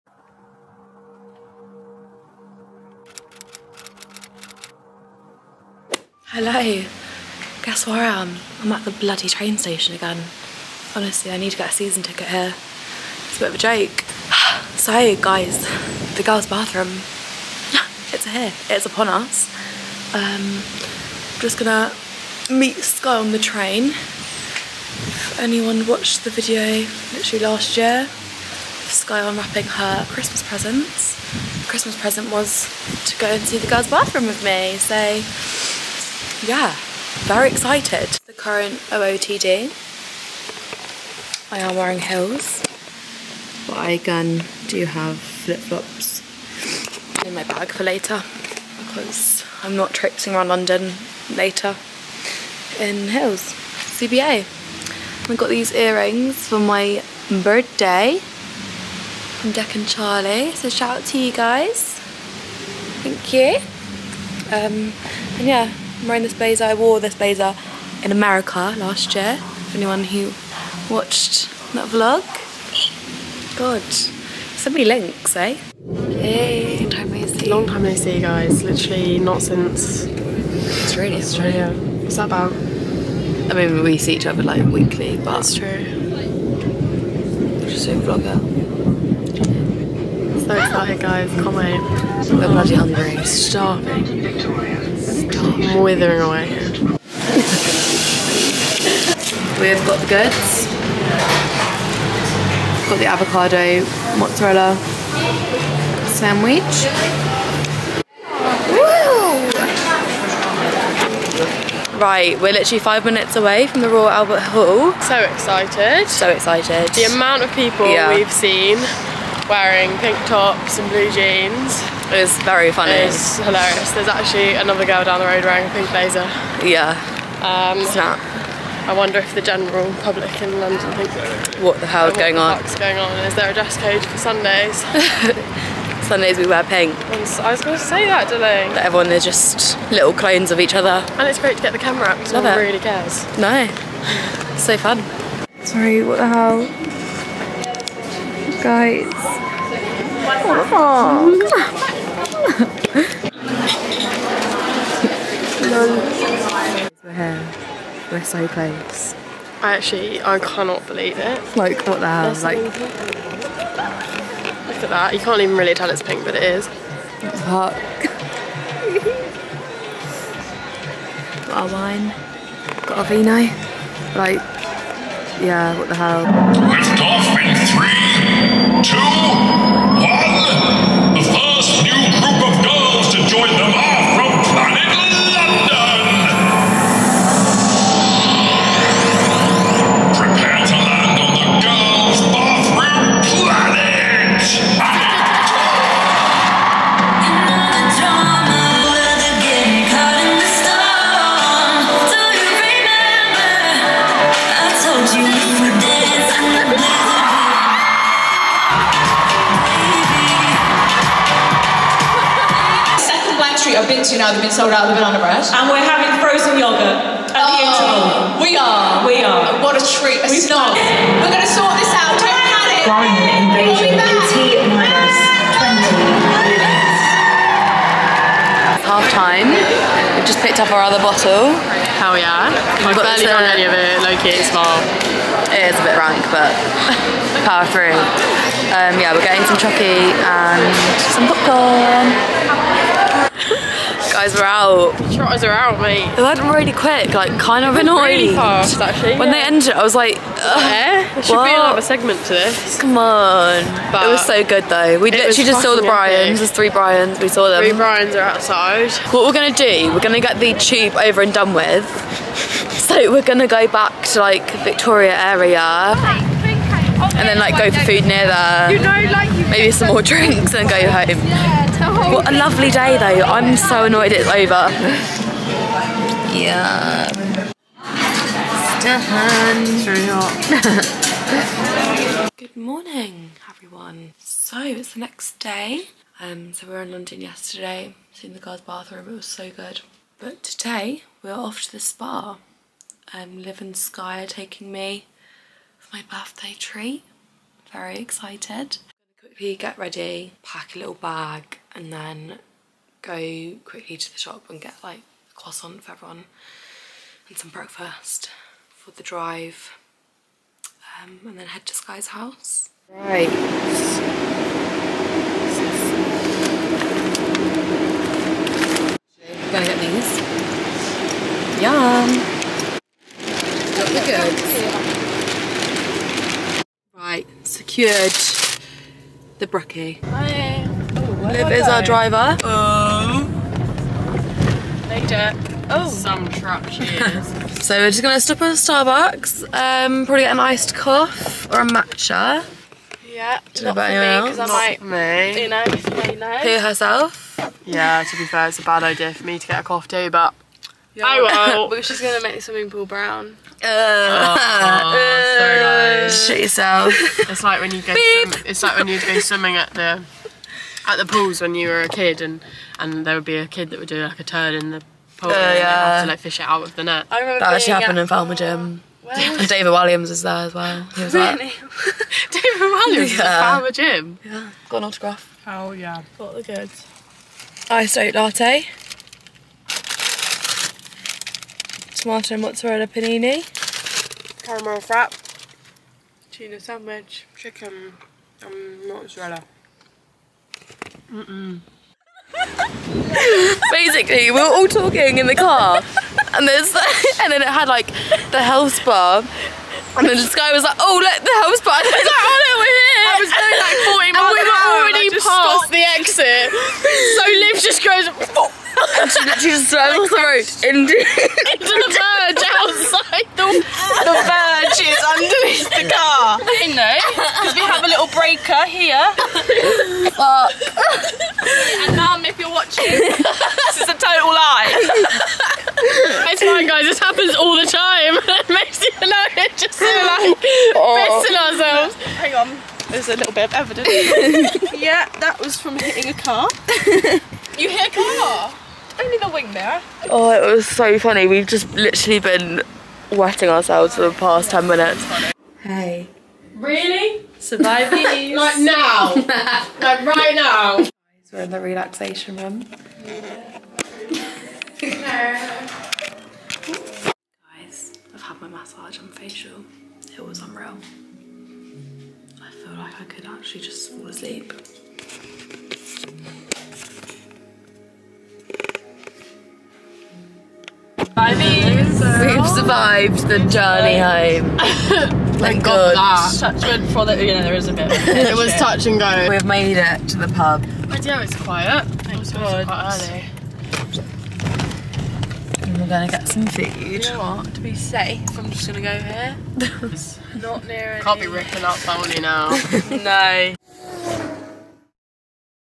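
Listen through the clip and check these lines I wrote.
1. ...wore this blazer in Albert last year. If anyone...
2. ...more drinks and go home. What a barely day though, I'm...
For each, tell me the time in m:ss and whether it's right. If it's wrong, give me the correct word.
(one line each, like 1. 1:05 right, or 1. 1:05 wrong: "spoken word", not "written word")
1. 1:06 wrong: "America", not "Albert"
2. 4:29 wrong: "lovely", not "barely".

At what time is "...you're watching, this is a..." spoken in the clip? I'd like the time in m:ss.
7:02.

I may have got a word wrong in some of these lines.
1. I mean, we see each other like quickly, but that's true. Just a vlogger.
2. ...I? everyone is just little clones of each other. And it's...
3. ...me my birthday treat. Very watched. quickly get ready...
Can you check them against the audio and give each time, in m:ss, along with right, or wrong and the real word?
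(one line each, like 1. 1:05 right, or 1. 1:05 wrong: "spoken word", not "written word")
1. 1:22 wrong: "weekly", not "quickly"
2. 2:18 right
3. 4:54 wrong: "excited", not "watched".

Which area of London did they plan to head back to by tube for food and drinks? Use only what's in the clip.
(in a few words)
Victoria.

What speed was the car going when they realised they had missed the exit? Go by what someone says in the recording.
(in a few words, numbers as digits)
40 miles.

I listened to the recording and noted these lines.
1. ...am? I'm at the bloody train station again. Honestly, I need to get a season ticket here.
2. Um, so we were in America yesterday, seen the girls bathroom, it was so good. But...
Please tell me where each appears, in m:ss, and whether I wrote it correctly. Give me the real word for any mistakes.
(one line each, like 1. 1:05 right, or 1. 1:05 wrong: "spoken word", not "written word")
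1. 0:08 right
2. 4:46 wrong: "London", not "America".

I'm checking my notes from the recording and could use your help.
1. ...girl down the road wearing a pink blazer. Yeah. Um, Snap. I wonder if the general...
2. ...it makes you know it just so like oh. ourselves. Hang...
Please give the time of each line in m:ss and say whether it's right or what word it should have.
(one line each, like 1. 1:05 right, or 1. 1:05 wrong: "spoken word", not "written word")
1. 2:04 right
2. 7:08 right.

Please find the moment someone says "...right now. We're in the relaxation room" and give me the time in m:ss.
7:30.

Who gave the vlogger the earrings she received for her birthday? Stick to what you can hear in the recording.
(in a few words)
Deck and Charlie.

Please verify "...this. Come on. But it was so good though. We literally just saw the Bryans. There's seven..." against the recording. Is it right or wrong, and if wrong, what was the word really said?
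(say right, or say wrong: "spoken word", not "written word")
wrong: "three", not "seven".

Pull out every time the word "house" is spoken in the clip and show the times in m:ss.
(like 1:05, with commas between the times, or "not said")
5:12.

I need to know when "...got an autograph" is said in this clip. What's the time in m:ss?
6:14.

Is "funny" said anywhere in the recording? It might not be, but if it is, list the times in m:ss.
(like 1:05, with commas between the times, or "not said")
2:02, 7:20.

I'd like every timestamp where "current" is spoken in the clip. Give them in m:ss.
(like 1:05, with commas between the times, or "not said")
0:38.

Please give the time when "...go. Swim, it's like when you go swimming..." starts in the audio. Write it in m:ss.
5:57.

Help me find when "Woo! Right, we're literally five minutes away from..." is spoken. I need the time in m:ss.
1:48.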